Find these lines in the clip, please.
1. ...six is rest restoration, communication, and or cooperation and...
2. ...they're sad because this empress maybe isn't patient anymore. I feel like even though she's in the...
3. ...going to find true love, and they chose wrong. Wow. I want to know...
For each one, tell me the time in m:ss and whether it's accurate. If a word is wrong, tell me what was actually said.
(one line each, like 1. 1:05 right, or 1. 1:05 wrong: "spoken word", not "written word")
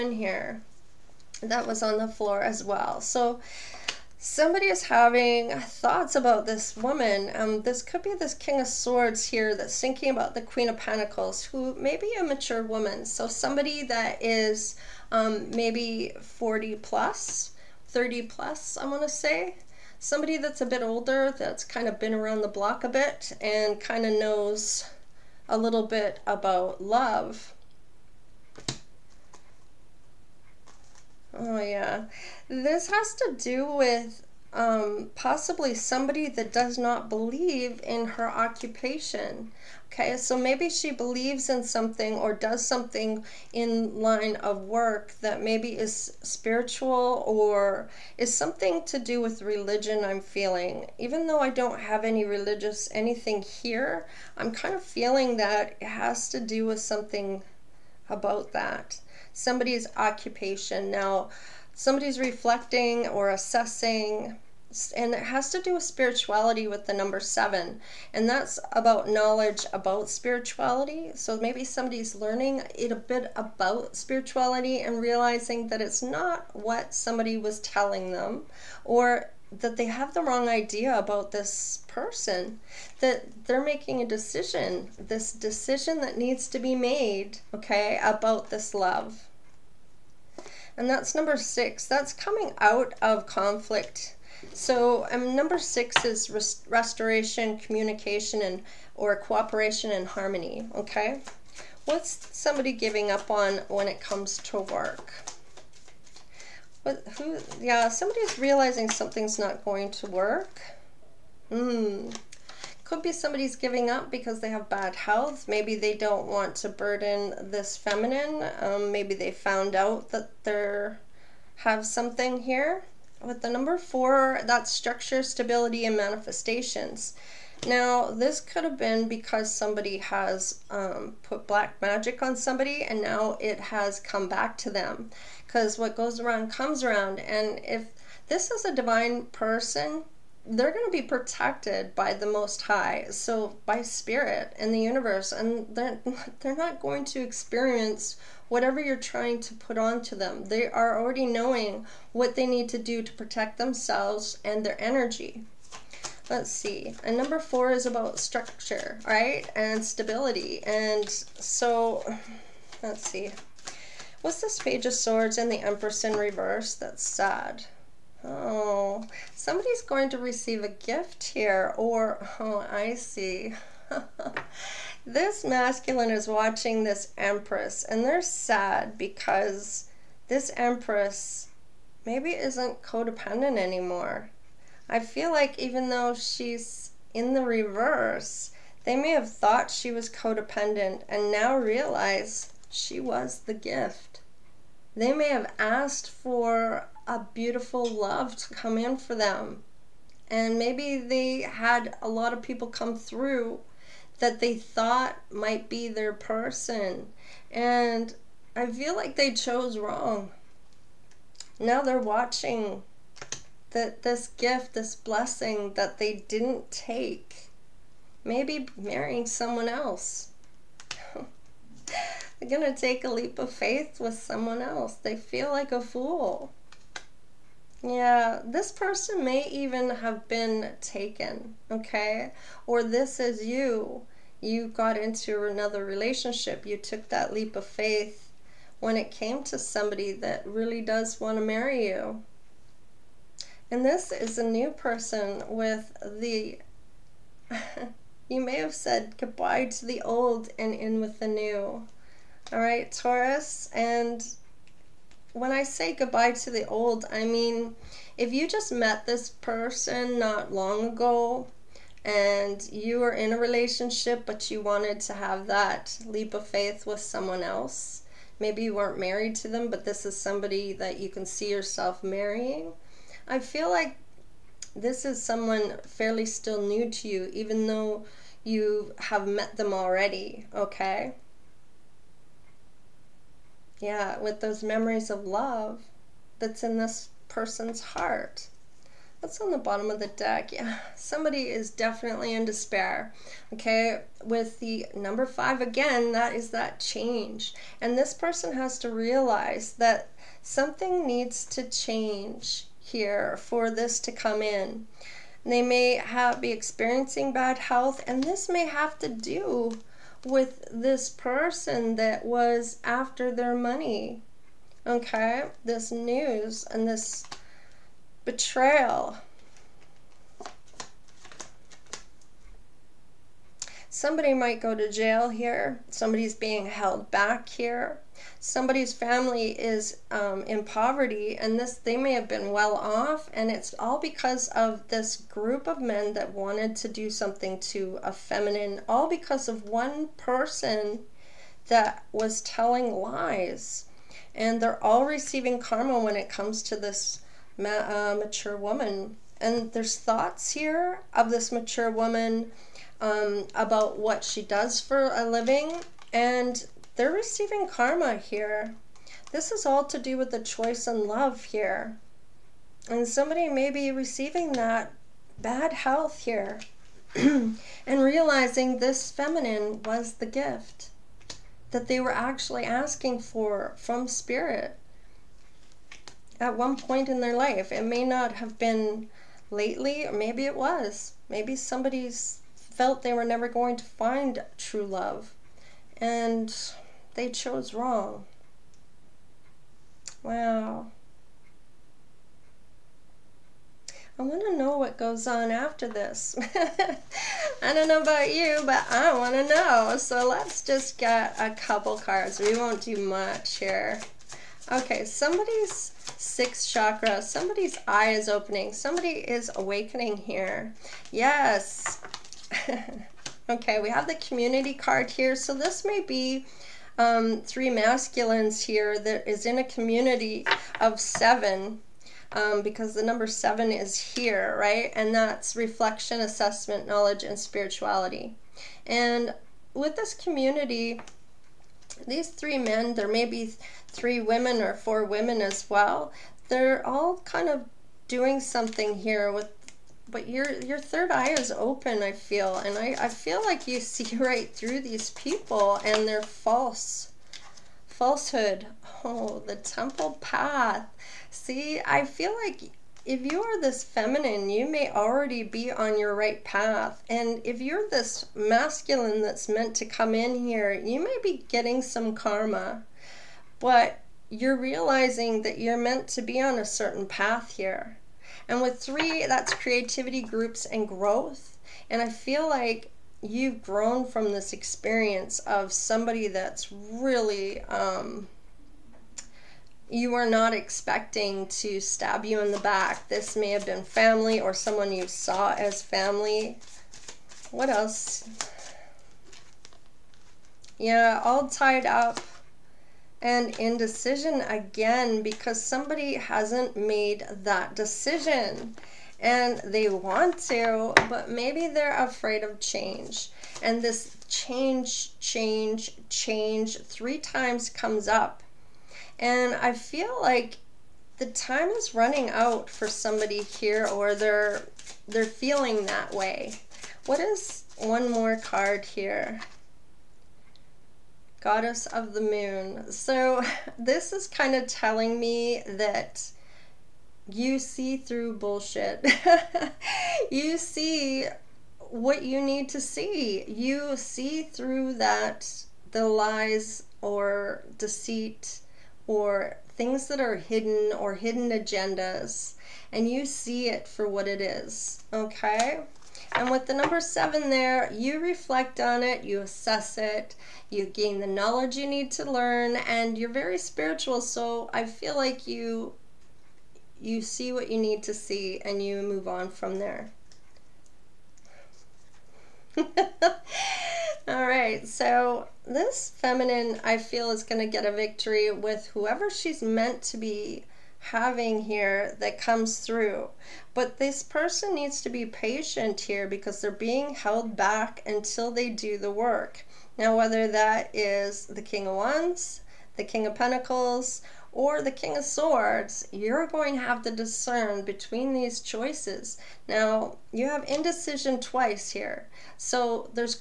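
1. 1:35 right
2. 2:58 wrong: "codependent", not "patient"
3. 6:23 right.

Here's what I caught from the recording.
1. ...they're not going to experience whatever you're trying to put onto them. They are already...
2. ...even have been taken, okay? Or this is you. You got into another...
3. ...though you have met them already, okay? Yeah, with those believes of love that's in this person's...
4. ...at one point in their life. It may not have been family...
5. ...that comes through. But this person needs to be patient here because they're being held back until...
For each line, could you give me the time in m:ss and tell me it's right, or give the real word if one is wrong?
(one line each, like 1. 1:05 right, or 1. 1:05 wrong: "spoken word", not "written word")
1. 2:26 right
2. 3:49 right
3. 4:37 wrong: "memories", not "believes"
4. 6:16 wrong: "lately", not "family"
5. 9:32 right.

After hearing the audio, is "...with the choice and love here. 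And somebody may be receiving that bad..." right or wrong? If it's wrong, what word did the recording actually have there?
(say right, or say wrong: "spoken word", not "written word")
right.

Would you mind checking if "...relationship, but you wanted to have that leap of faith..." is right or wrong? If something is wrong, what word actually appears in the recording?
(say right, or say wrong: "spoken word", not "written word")
right.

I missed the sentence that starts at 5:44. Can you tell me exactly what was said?
And they're all receiving karma when it comes to this ma- uh, mature woman.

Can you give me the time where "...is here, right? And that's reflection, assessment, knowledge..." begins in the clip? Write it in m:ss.
7:03.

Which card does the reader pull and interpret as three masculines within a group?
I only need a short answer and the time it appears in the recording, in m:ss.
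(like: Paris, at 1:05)
the community card, at 6:54.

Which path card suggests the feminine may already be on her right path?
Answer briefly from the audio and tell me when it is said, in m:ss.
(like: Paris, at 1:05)
the temple path, at 7:29.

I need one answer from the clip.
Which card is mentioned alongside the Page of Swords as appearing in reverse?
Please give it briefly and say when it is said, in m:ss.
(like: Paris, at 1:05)
the Empress, at 2:45.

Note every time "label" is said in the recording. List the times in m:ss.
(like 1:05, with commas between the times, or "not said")
not said.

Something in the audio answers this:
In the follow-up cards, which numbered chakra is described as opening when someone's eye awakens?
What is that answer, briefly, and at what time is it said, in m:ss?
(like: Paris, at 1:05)
sixth chakra, at 6:46.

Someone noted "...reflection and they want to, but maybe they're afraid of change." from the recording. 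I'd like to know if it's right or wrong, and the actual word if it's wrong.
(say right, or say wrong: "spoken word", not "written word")
wrong: "decision", not "reflection".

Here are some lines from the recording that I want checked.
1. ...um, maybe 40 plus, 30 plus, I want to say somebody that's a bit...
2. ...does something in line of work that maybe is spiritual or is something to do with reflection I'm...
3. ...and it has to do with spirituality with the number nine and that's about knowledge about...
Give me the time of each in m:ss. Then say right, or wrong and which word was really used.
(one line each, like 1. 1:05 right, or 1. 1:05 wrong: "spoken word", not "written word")
1. 0:15 right
2. 0:42 wrong: "religion", not "reflection"
3. 1:04 wrong: "seven", not "nine".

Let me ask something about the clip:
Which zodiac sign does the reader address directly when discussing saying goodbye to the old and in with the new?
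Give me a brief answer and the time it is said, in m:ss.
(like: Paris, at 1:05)
Taurus, at 4:12.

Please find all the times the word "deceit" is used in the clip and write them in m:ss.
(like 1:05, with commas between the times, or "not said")
8:57.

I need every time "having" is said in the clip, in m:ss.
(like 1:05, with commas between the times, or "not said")
0:04, 9:31.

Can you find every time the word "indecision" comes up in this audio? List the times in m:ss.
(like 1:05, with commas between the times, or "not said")
8:13, 9:50.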